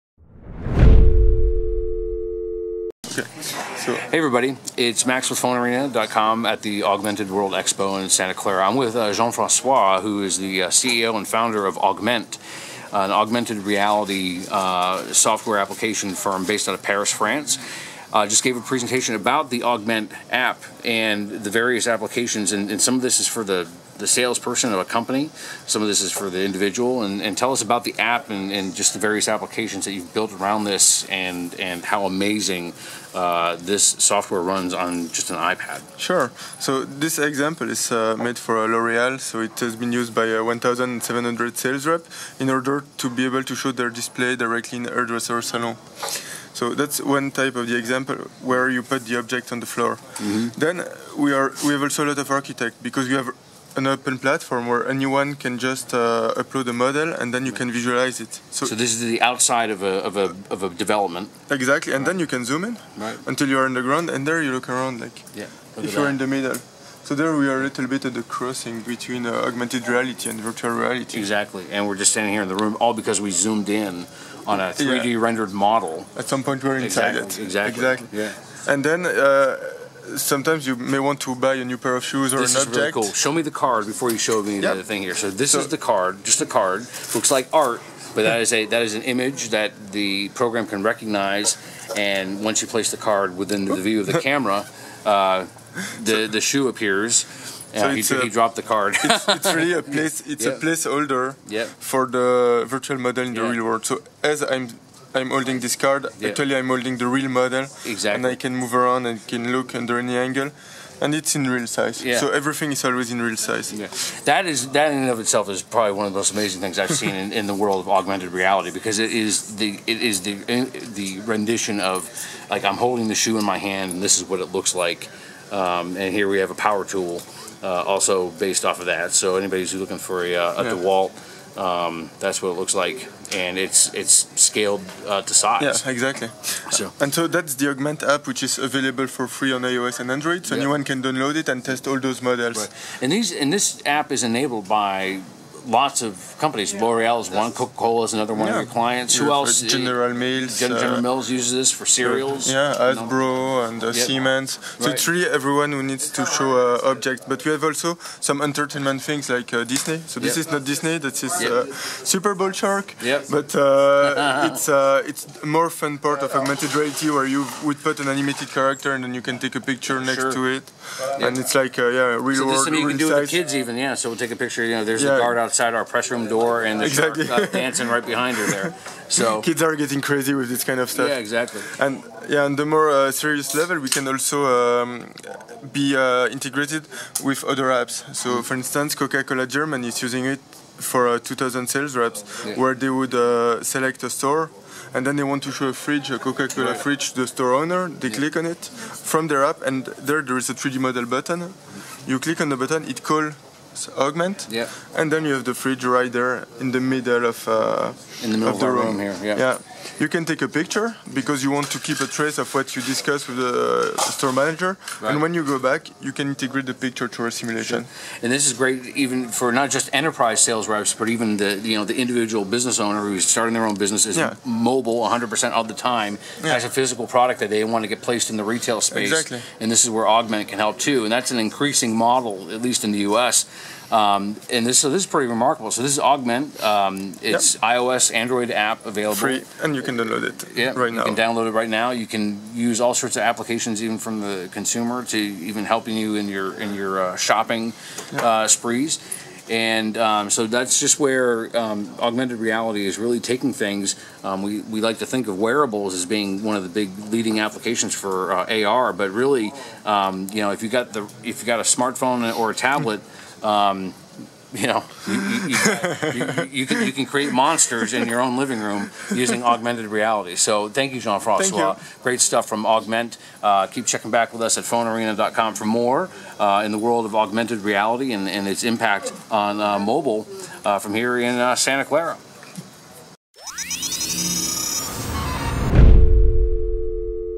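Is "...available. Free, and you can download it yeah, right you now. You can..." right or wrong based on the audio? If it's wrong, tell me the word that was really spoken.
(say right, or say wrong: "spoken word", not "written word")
right.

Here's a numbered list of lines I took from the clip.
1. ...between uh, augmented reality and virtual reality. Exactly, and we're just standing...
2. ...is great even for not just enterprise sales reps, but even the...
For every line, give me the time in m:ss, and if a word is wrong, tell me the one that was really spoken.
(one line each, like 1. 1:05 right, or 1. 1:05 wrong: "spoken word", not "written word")
1. 1:08 right
2. 3:38 right.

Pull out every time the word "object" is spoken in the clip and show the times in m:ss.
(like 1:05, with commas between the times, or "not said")
0:49, 1:22, 2:36.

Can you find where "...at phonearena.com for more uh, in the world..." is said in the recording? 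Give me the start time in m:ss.
4:34.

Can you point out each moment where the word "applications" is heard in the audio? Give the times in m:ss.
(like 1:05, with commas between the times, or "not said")
0:15, 0:21, 0:29, 4:03, 4:17.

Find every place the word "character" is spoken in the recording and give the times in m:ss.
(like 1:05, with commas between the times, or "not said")
2:48.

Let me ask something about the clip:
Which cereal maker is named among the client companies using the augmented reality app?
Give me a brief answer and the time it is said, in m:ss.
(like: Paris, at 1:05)
General Mills, at 2:29.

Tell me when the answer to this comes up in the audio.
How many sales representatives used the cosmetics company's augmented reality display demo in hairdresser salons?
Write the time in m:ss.
0:40.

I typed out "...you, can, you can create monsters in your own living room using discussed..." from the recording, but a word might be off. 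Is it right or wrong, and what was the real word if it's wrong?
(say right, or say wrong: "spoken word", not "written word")
wrong: "augmented", not "discussed".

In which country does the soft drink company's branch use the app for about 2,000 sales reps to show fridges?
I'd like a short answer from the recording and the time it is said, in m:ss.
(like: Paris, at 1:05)
Germany, at 3:09.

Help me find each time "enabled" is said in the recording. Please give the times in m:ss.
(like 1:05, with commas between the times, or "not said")
2:24.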